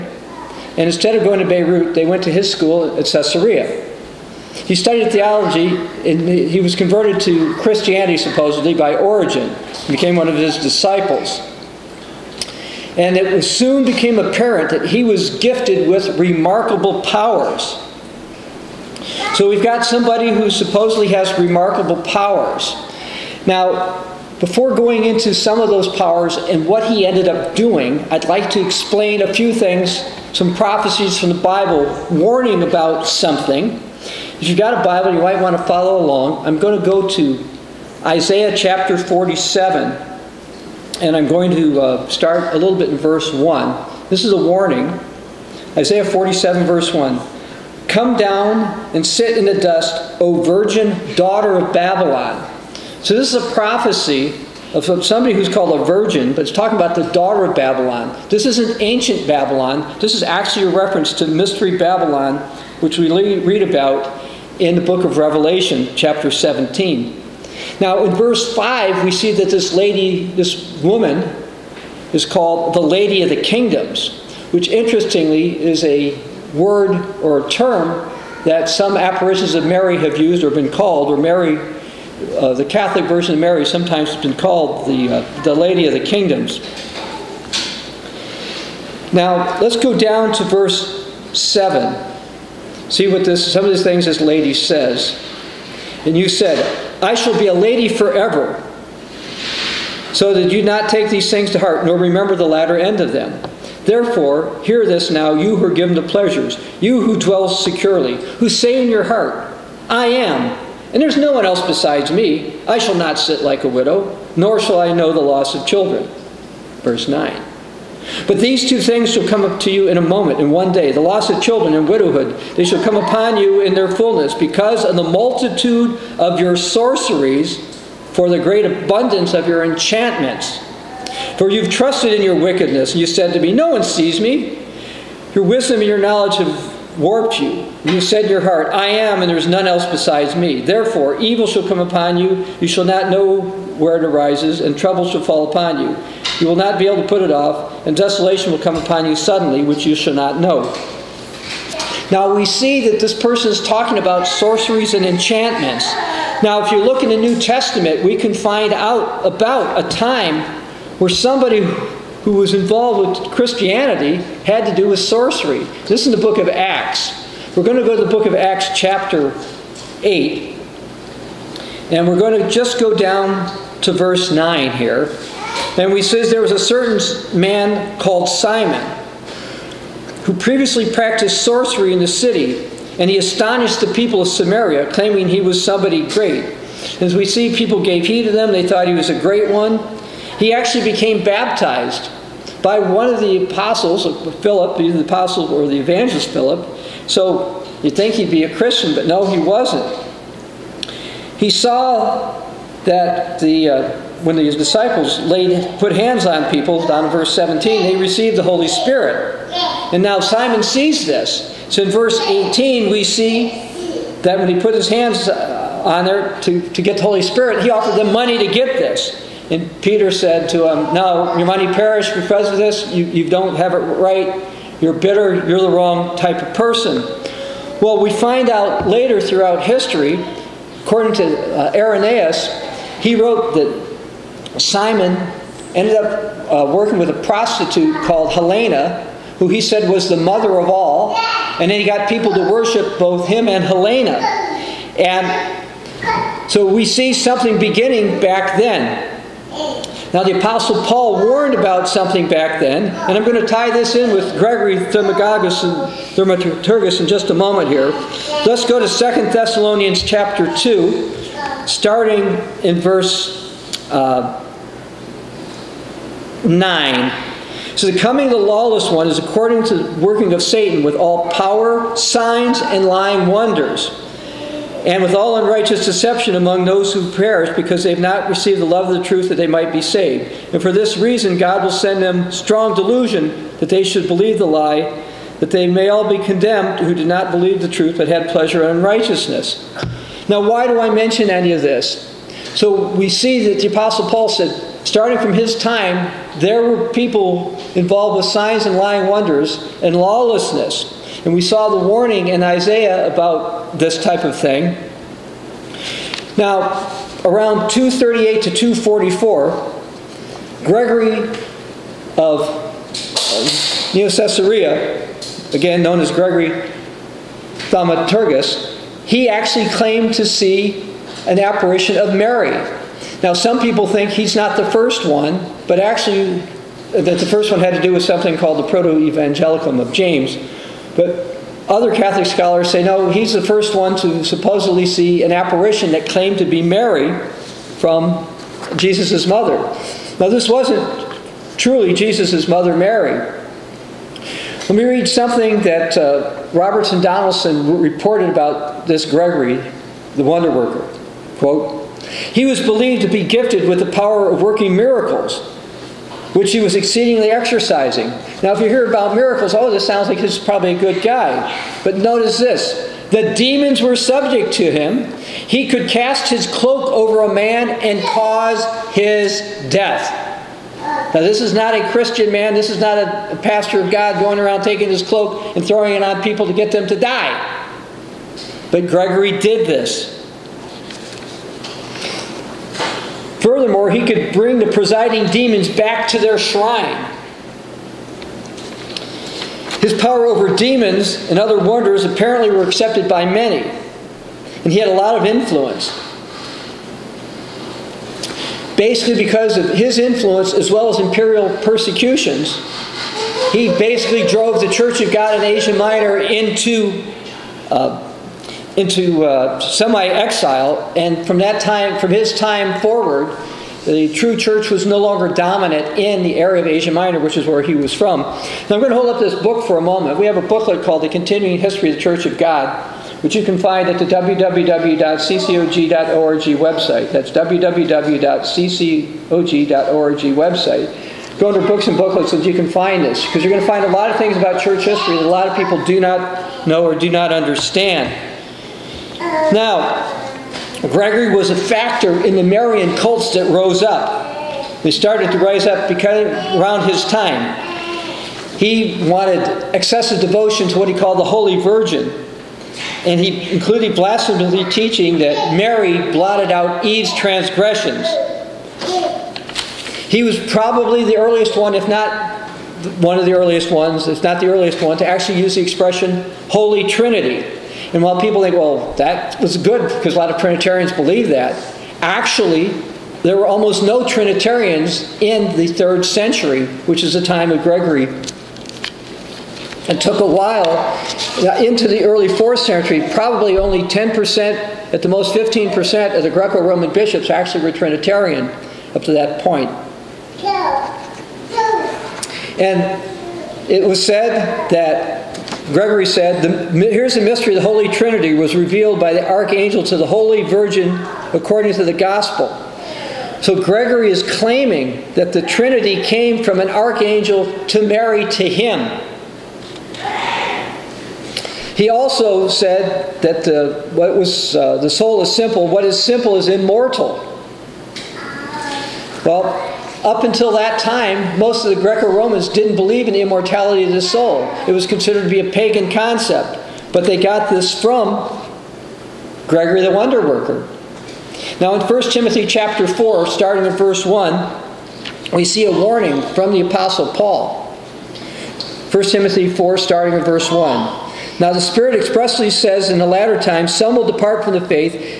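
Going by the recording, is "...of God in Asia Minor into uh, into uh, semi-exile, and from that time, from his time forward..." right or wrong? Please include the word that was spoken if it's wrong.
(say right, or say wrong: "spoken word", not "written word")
right.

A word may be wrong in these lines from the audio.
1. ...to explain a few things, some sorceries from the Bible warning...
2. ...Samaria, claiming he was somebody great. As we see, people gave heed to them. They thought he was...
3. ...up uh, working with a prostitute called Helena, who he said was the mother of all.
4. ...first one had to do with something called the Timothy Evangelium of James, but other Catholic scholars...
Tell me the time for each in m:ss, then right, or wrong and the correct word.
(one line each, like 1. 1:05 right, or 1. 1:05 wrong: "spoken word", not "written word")
1. 0:28 wrong: "prophecies", not "sorceries"
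2. 3:04 right
3. 3:55 right
4. 5:27 wrong: "Proto", not "Timothy".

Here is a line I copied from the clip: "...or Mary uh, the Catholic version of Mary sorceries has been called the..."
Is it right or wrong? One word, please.
wrong.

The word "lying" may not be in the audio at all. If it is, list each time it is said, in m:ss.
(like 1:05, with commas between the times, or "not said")
4:32, 4:58.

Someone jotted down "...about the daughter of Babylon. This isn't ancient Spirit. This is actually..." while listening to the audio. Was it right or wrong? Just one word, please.
wrong.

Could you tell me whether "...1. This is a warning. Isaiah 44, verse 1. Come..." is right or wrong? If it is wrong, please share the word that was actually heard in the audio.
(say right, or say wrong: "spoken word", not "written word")
wrong: "47", not "44".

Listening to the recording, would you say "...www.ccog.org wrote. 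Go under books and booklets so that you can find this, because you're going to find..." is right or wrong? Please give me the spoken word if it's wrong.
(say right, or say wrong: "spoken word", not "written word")
wrong: "website", not "wrote".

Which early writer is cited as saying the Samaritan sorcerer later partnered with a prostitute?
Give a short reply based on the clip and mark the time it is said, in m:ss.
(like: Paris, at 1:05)
Irenaeus, at 3:51.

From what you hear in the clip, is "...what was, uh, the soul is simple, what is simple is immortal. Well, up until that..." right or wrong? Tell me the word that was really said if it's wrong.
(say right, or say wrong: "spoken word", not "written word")
right.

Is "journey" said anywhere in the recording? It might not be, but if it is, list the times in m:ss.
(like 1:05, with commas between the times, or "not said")
not said.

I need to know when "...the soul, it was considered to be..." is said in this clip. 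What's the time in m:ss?
8:43.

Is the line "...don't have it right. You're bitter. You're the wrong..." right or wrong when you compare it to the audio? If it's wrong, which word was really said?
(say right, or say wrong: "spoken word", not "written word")
right.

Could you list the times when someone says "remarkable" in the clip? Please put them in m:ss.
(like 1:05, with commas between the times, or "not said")
0:16, 0:21.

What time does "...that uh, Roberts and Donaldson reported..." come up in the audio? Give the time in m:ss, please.
5:45.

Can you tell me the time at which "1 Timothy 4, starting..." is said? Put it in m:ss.
8:58.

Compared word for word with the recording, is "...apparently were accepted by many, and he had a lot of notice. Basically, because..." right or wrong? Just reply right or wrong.
wrong.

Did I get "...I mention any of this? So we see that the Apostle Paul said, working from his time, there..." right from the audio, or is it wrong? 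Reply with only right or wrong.
wrong.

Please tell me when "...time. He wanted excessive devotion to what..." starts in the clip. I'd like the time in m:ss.
7:27.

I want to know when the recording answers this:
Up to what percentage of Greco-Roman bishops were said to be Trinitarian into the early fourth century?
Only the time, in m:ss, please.
8:05.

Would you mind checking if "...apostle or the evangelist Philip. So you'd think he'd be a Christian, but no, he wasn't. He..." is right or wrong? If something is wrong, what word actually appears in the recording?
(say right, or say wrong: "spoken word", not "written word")
right.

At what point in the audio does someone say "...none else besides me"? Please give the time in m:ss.
2:19.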